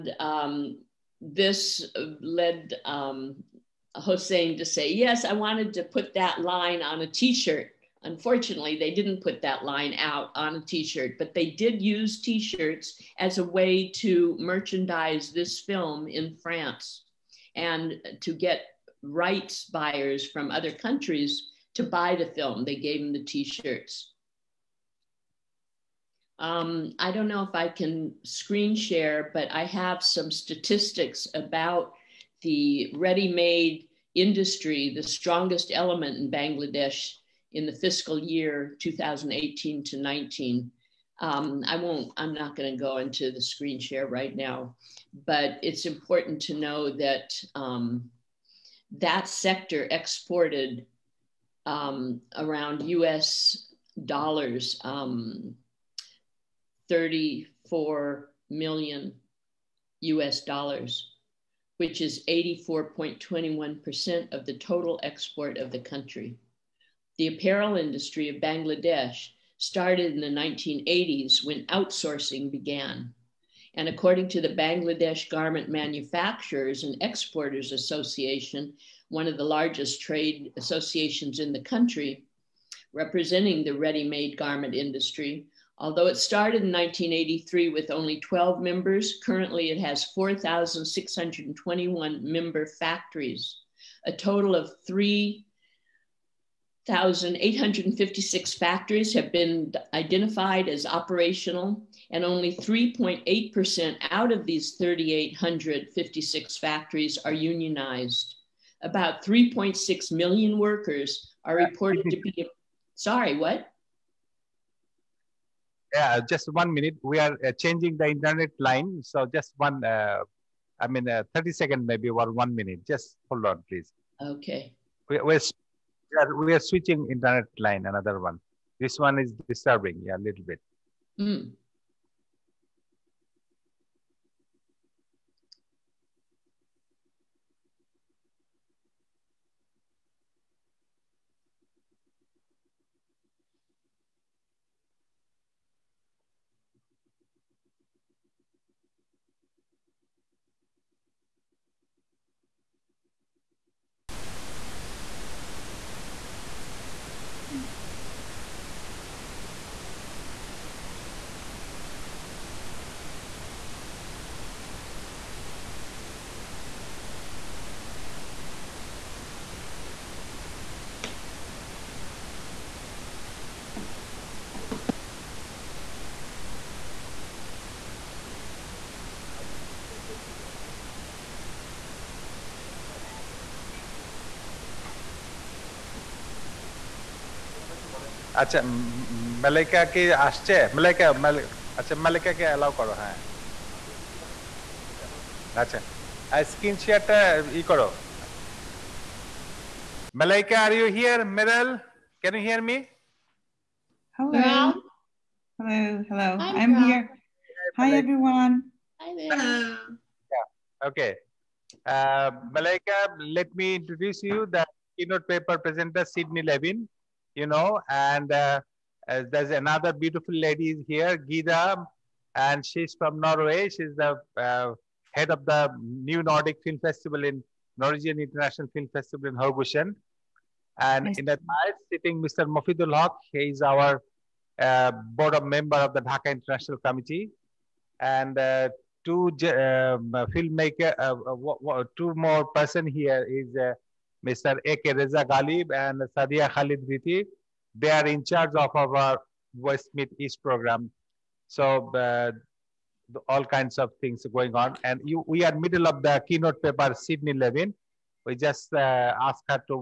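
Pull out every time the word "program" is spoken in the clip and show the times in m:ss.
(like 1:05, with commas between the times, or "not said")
4:10.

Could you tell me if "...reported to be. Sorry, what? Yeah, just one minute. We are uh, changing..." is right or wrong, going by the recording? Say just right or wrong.
right.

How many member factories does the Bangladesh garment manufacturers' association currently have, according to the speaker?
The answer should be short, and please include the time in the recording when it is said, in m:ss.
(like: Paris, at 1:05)
4,621, at 1:30.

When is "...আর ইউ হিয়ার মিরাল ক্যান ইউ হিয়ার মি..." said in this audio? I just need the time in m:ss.
3:20.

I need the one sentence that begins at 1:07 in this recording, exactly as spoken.
The apparel industry of Bangladesh started in the 1980s when outsourcing began.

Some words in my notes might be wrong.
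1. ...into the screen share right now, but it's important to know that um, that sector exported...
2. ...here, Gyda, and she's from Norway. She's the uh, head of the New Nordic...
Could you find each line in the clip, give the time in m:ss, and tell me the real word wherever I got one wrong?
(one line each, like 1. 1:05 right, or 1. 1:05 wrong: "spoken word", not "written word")
1. 0:42 right
2. 3:40 right.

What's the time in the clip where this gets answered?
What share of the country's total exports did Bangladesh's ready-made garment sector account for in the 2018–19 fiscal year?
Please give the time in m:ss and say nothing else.
1:02.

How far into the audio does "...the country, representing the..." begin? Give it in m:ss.
1:21.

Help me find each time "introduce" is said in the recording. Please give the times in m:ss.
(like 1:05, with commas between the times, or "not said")
3:33.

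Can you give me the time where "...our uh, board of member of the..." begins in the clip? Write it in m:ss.
3:53.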